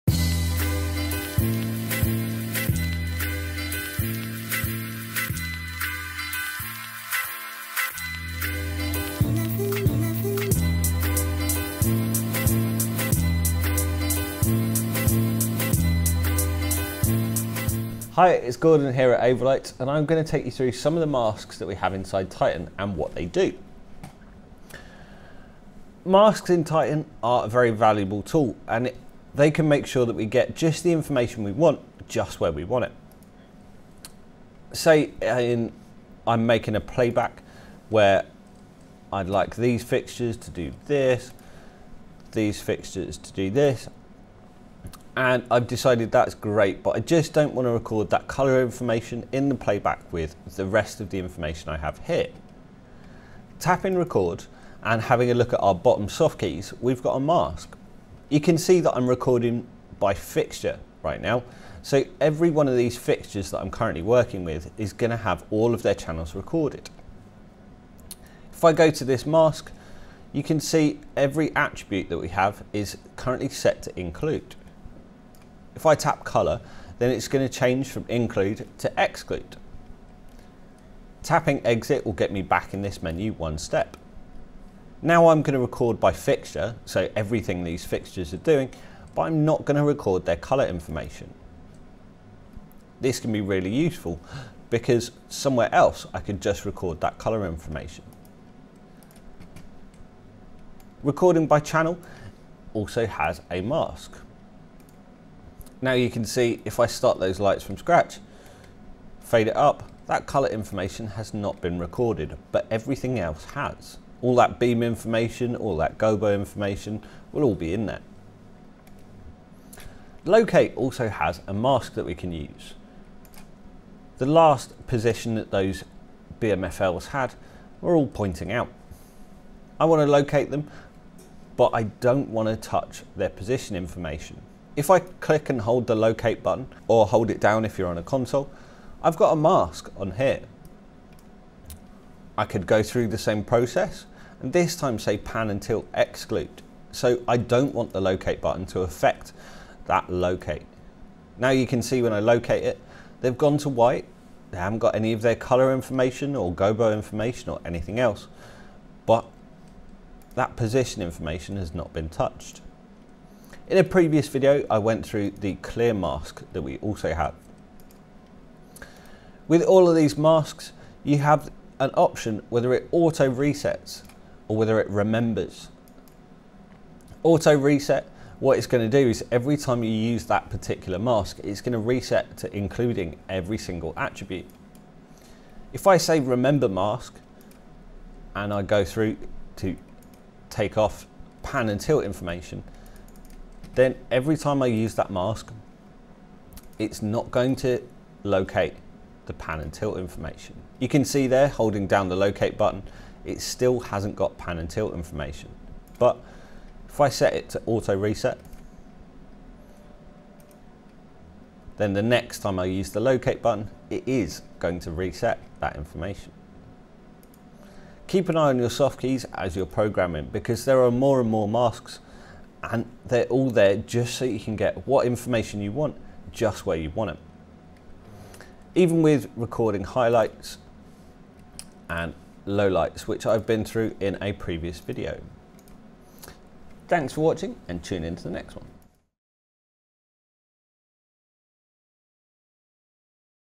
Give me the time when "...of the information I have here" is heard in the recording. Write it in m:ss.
0:51.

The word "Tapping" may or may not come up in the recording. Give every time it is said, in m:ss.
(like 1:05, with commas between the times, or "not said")
0:53, 1:21.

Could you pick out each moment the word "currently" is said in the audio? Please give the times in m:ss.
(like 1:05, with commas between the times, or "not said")
1:03, 1:13.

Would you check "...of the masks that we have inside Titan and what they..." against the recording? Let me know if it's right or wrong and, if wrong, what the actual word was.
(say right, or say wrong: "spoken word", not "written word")
right.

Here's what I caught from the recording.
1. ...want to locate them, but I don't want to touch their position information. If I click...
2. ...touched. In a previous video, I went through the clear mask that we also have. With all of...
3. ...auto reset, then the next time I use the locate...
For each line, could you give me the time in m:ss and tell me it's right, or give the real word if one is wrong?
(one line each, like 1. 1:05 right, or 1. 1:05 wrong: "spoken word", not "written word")
1. 2:09 right
2. 2:42 right
3. 3:27 right.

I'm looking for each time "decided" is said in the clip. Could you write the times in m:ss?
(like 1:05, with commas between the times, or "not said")
0:45.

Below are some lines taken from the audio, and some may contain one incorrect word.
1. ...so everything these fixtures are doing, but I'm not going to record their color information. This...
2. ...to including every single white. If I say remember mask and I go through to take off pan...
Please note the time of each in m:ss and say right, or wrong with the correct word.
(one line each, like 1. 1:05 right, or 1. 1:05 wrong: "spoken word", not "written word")
1. 1:26 right
2. 3:02 wrong: "attribute", not "white".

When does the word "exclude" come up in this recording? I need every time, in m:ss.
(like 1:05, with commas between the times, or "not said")
1:18, 2:25.